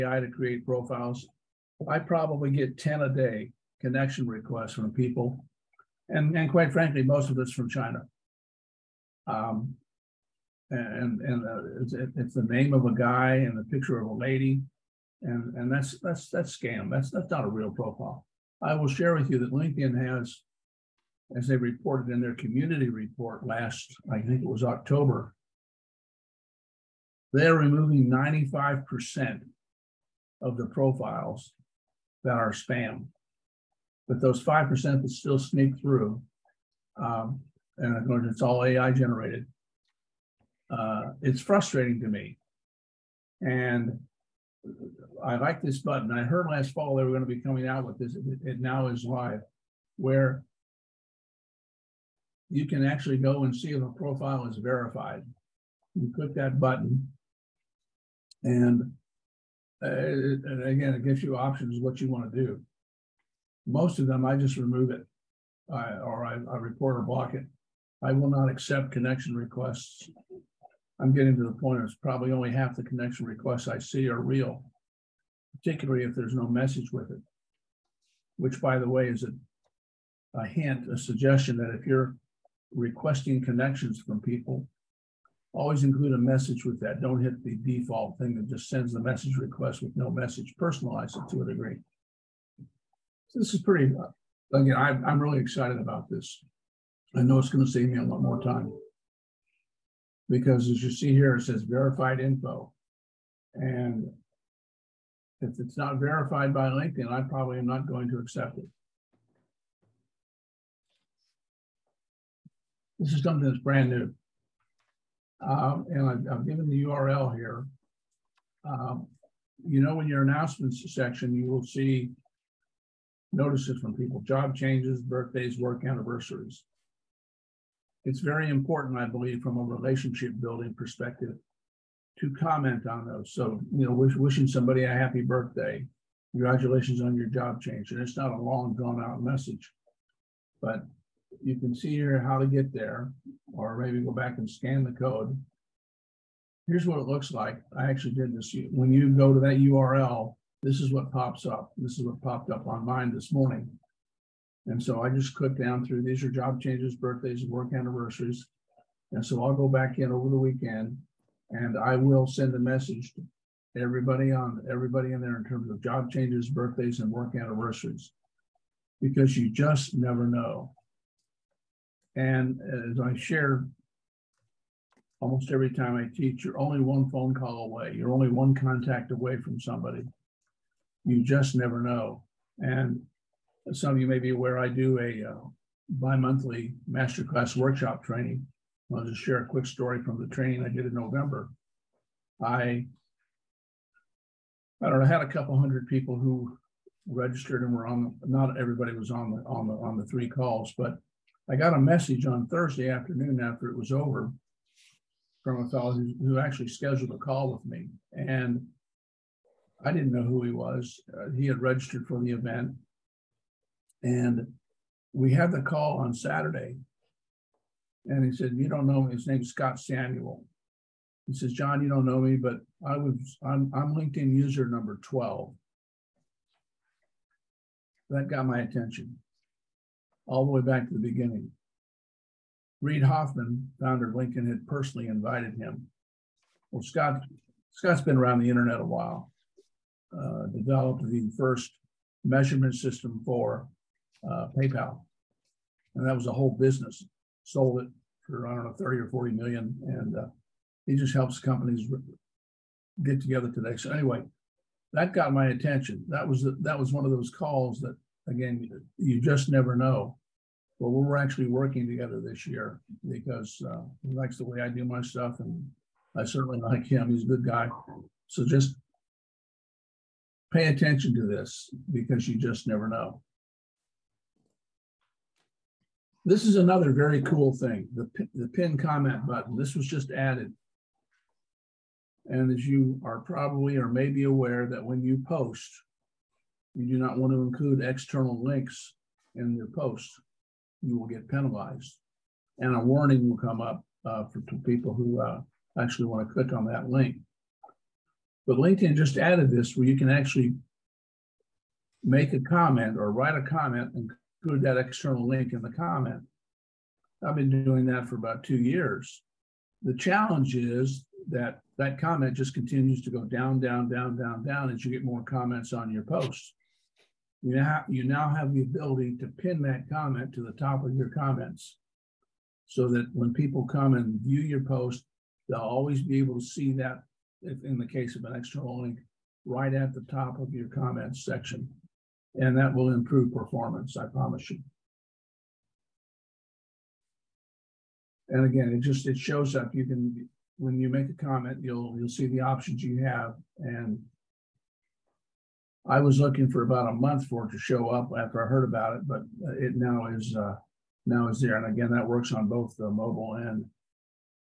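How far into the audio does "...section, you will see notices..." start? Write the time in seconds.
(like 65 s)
120 s.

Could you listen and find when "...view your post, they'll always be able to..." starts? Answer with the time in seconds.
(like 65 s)
324 s.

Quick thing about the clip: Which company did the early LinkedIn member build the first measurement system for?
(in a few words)
PayPal.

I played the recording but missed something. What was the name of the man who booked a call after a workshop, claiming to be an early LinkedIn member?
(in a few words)
Scott Samuel.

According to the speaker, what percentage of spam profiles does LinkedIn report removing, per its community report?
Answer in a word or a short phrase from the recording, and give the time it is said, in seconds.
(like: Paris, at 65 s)
95%, at 28 s.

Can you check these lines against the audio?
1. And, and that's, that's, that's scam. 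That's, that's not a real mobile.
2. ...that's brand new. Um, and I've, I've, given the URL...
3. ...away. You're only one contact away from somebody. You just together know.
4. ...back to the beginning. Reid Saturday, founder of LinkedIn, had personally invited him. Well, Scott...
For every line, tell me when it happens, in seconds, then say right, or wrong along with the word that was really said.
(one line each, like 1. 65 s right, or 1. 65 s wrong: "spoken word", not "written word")
1. 15 s wrong: "profile", not "mobile"
2. 113 s right
3. 177 s wrong: "never", not "together"
4. 230 s wrong: "Hoffman", not "Saturday".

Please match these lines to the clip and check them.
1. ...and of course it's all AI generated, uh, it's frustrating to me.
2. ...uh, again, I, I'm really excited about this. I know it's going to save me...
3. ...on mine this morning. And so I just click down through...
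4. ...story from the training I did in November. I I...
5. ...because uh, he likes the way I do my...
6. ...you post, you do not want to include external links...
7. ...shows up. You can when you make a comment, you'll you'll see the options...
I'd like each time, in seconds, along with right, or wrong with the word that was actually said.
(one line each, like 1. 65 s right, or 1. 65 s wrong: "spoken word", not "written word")
1. 37 s right
2. 93 s right
3. 152 s right
4. 189 s right
5. 263 s right
6. 285 s right
7. 339 s right.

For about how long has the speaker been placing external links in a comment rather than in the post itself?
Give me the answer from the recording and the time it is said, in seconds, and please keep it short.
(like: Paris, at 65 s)
about 2 years, at 308 s.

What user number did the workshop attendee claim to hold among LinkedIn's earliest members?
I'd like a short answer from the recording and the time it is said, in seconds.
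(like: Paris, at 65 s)
12, at 224 s.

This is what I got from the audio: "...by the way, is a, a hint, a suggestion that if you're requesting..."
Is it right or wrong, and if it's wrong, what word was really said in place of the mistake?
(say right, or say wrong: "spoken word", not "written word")
right.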